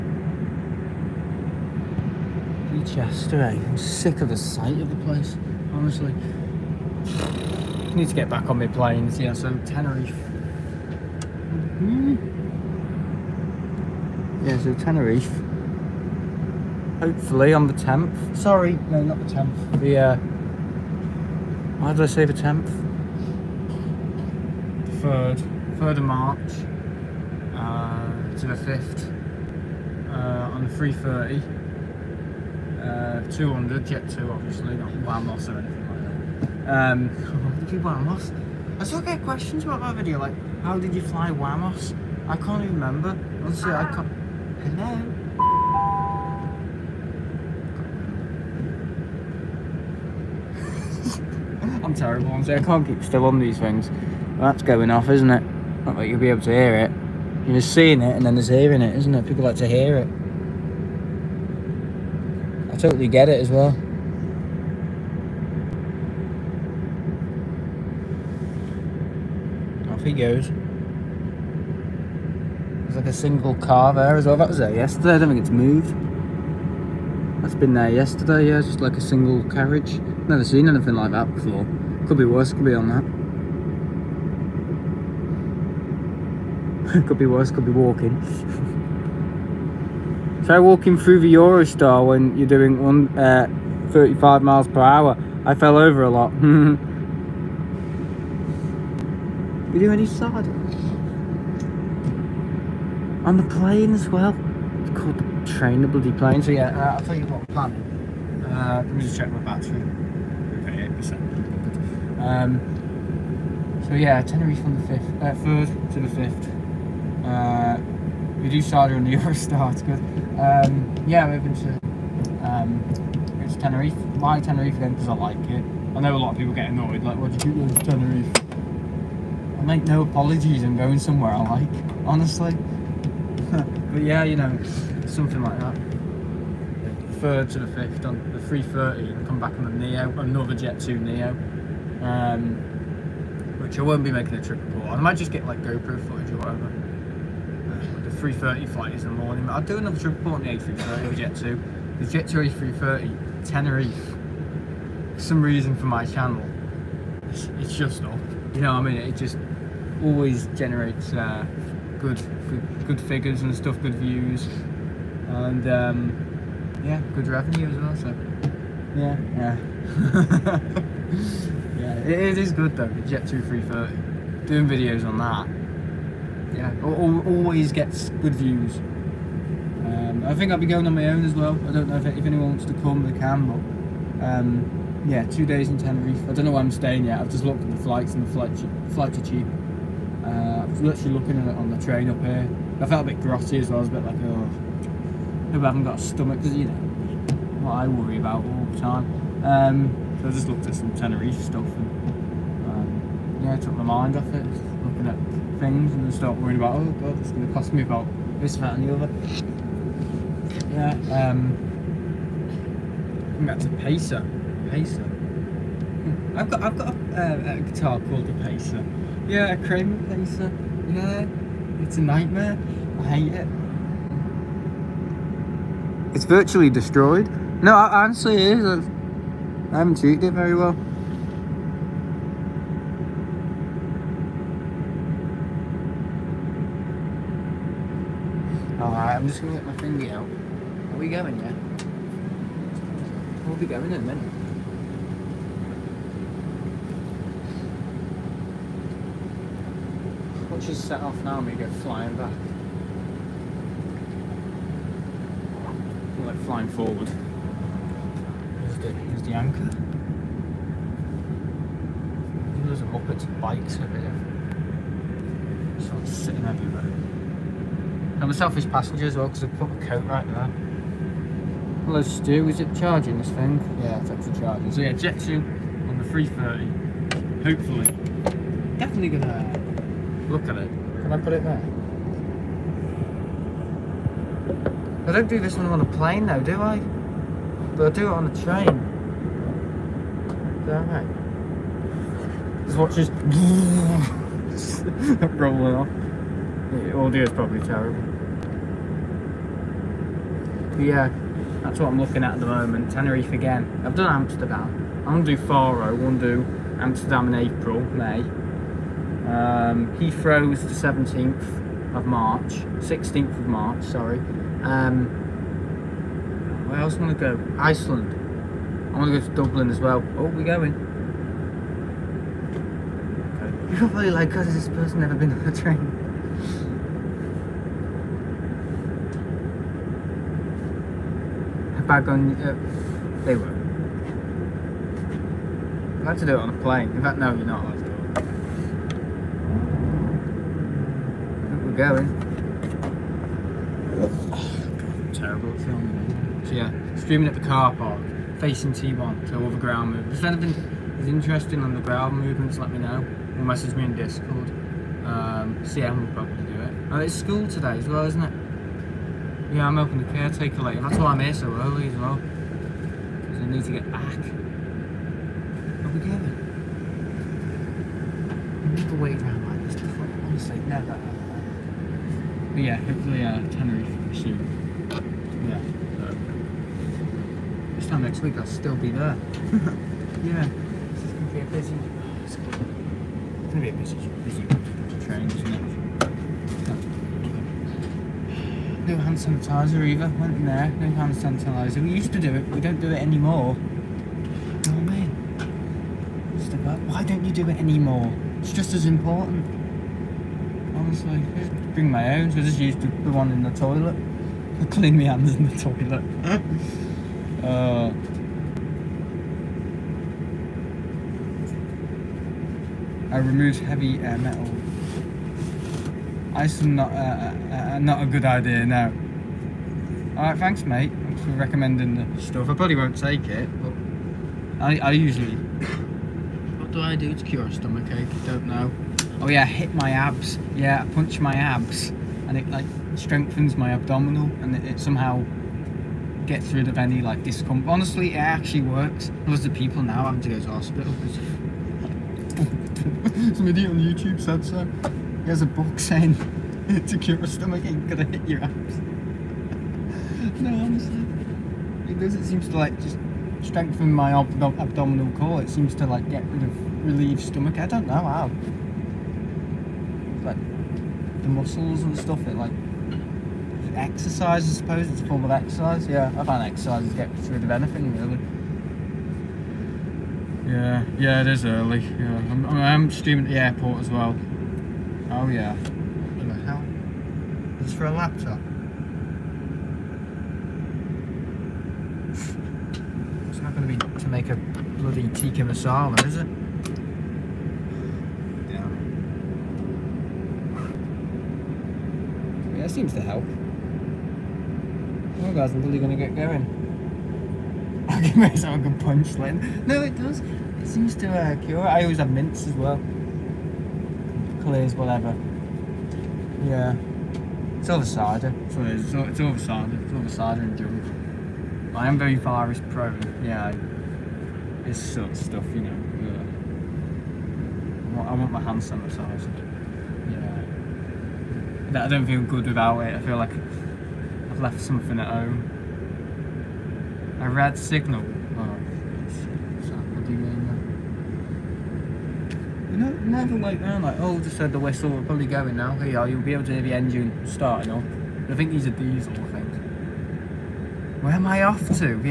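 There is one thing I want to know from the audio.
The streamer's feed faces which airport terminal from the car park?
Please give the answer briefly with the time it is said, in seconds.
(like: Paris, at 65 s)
T1, at 348 s.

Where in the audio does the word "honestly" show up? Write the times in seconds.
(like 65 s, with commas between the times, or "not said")
5 s, 43 s, 132 s, 227 s, 370 s, 400 s, 437 s, 450 s.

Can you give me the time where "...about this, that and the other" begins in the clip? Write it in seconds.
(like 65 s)
207 s.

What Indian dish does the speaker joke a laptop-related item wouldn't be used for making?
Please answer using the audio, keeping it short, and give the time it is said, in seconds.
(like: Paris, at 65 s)
Tikka masala, at 485 s.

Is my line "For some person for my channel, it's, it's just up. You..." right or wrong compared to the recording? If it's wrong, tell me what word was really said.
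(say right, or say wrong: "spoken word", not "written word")
wrong: "reason", not "person".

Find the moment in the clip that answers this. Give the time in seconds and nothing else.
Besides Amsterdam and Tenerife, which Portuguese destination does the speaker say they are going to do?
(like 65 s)
305 s.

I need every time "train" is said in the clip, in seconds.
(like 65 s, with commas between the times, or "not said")
105 s, 191 s, 288 s, 325 s, 385 s.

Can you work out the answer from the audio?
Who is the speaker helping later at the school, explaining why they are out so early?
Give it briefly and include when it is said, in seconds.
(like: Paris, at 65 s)
The caretaker, at 360 s.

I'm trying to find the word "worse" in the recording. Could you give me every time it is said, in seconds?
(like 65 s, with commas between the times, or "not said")
82 s, 87 s.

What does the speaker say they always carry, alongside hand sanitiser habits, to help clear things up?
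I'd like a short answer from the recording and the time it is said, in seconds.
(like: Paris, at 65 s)
Mints, at 502 s.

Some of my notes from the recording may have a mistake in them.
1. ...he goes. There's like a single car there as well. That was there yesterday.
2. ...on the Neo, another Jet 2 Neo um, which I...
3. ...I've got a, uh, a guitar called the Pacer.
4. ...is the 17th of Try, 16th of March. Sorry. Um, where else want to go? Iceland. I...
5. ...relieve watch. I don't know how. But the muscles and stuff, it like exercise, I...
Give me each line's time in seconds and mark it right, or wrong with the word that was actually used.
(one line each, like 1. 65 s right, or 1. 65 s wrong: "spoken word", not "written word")
1. 70 s right
2. 139 s right
3. 216 s right
4. 310 s wrong: "March", not "Try"
5. 456 s wrong: "stomach", not "watch".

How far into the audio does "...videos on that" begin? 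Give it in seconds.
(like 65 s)
174 s.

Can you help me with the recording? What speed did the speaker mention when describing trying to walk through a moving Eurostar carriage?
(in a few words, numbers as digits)
35 miles per hour.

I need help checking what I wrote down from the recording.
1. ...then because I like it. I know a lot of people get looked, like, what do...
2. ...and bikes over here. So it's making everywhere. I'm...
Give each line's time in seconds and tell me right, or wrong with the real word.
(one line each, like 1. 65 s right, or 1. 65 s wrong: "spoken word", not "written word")
1. 124 s wrong: "annoyed", not "looked"
2. 263 s wrong: "sitting", not "making".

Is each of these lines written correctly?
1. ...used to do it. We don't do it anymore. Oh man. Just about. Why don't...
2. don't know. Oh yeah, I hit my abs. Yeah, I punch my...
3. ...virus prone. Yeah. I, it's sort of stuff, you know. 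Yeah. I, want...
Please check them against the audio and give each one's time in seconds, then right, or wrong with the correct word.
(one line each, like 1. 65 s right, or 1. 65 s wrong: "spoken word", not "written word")
1. 391 s right
2. 428 s right
3. 512 s right.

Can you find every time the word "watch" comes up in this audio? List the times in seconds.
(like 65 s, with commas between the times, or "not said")
250 s, 292 s.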